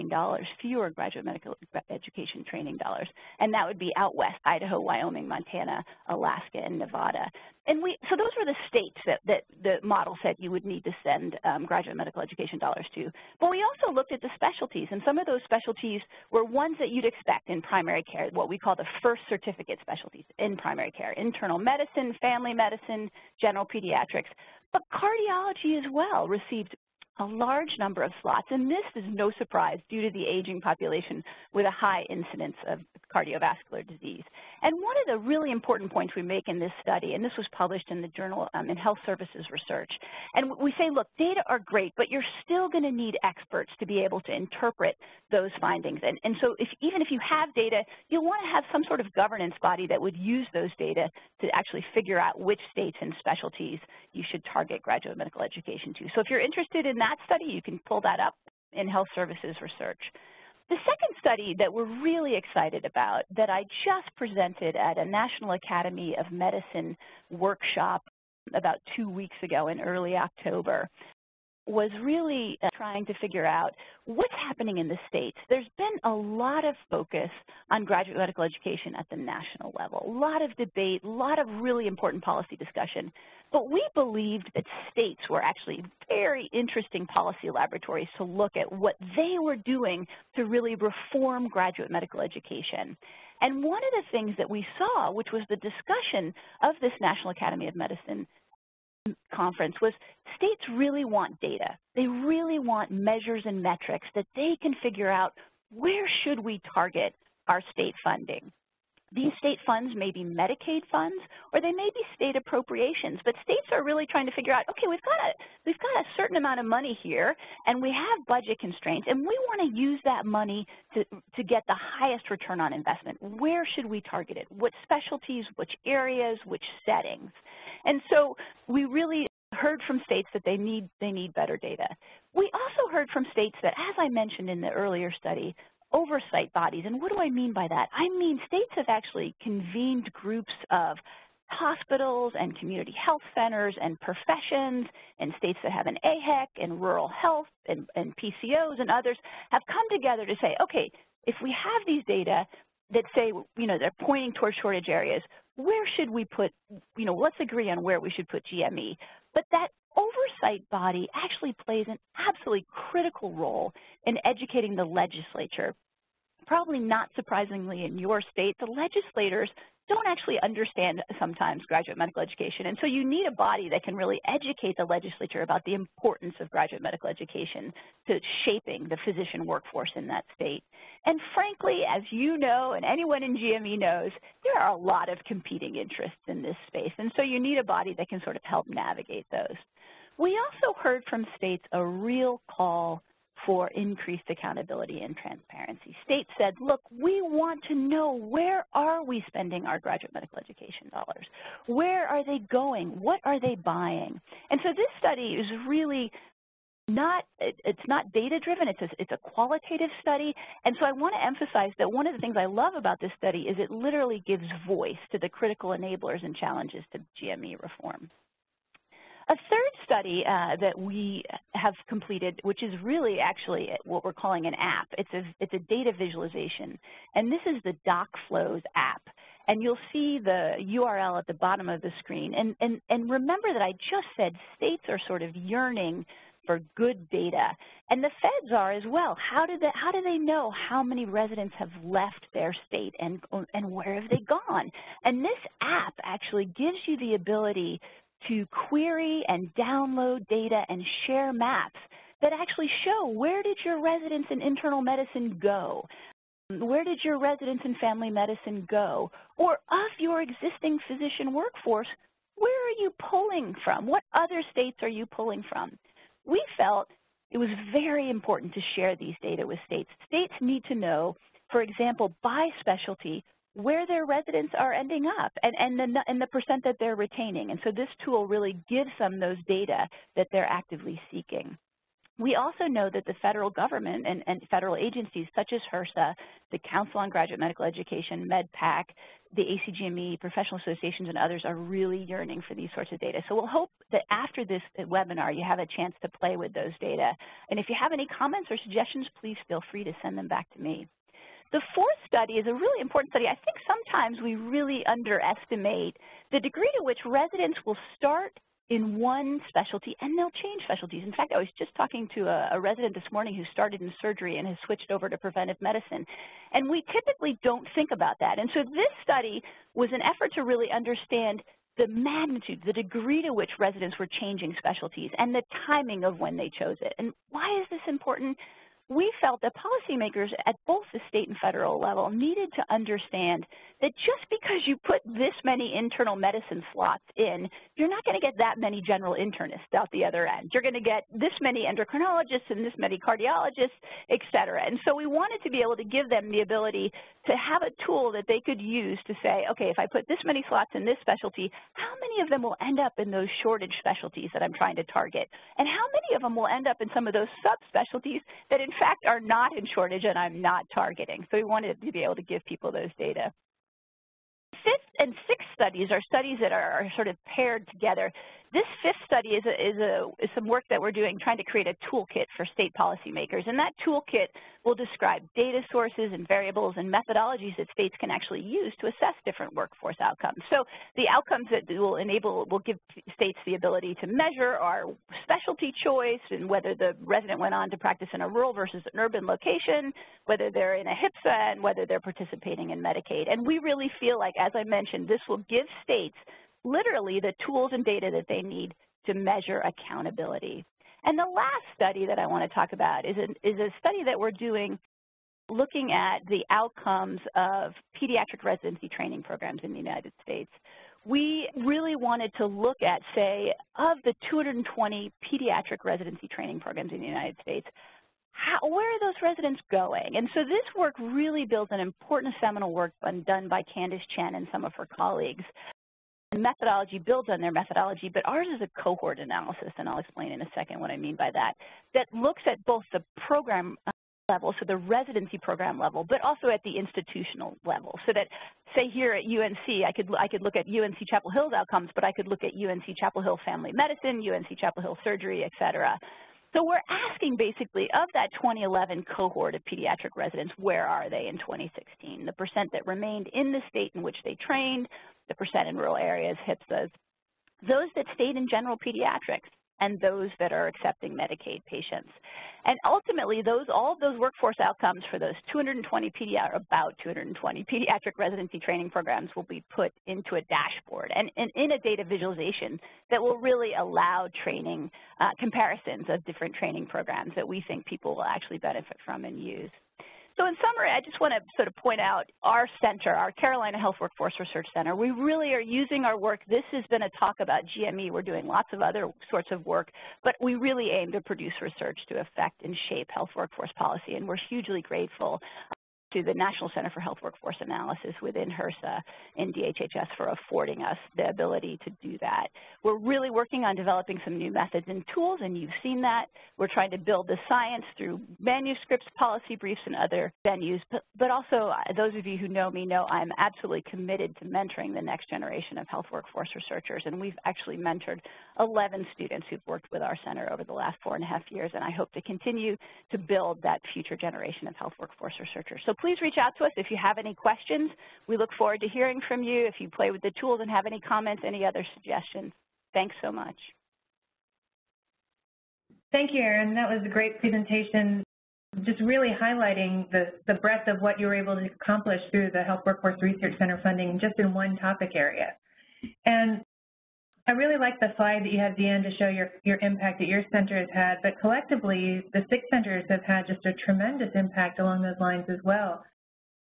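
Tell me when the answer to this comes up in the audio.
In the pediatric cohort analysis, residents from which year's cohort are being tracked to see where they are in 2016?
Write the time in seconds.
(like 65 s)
448 s.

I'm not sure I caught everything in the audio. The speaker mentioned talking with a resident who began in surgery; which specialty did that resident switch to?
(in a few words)
Preventive medicine.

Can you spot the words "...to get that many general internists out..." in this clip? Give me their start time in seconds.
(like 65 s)
338 s.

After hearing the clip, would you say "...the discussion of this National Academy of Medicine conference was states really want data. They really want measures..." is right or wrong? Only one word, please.
right.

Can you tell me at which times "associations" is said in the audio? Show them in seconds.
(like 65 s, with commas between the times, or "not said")
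290 s.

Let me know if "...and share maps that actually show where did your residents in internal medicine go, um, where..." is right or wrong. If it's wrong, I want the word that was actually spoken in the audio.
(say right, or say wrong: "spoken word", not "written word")
right.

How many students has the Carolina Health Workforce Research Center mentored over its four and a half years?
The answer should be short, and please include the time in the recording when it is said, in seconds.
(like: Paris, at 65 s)
11, at 518 s.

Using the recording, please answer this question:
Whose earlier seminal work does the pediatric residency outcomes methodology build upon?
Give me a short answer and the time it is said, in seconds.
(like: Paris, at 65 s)
Candice Chen, at 423 s.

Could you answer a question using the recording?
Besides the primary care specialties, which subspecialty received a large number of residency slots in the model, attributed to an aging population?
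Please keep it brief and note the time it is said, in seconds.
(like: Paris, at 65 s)
Cardiology, at 24 s.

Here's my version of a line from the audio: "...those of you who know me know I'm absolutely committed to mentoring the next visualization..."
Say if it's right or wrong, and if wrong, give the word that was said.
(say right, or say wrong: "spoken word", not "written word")
wrong: "generation", not "visualization".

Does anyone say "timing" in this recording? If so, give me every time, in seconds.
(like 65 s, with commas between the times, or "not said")
325 s.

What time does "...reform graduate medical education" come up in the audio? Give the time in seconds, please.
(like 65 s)
90 s.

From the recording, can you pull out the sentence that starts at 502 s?
We're really working on developing some new methods and tools, and you've seen that.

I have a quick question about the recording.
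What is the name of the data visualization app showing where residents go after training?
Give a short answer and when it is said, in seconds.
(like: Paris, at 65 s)
DocFlows, at 227 s.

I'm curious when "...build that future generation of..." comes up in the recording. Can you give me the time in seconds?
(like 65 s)
523 s.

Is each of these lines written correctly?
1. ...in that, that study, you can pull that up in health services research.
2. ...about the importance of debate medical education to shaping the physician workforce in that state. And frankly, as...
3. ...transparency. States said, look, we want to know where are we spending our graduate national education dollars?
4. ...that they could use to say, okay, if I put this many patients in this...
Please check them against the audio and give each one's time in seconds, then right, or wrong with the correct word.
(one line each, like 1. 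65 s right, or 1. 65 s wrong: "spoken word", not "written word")
1. 56 s right
2. 175 s wrong: "graduate", not "debate"
3. 195 s wrong: "medical", not "national"
4. 348 s wrong: "slots", not "patients".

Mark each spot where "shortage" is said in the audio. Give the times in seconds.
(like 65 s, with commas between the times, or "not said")
154 s, 353 s, 359 s.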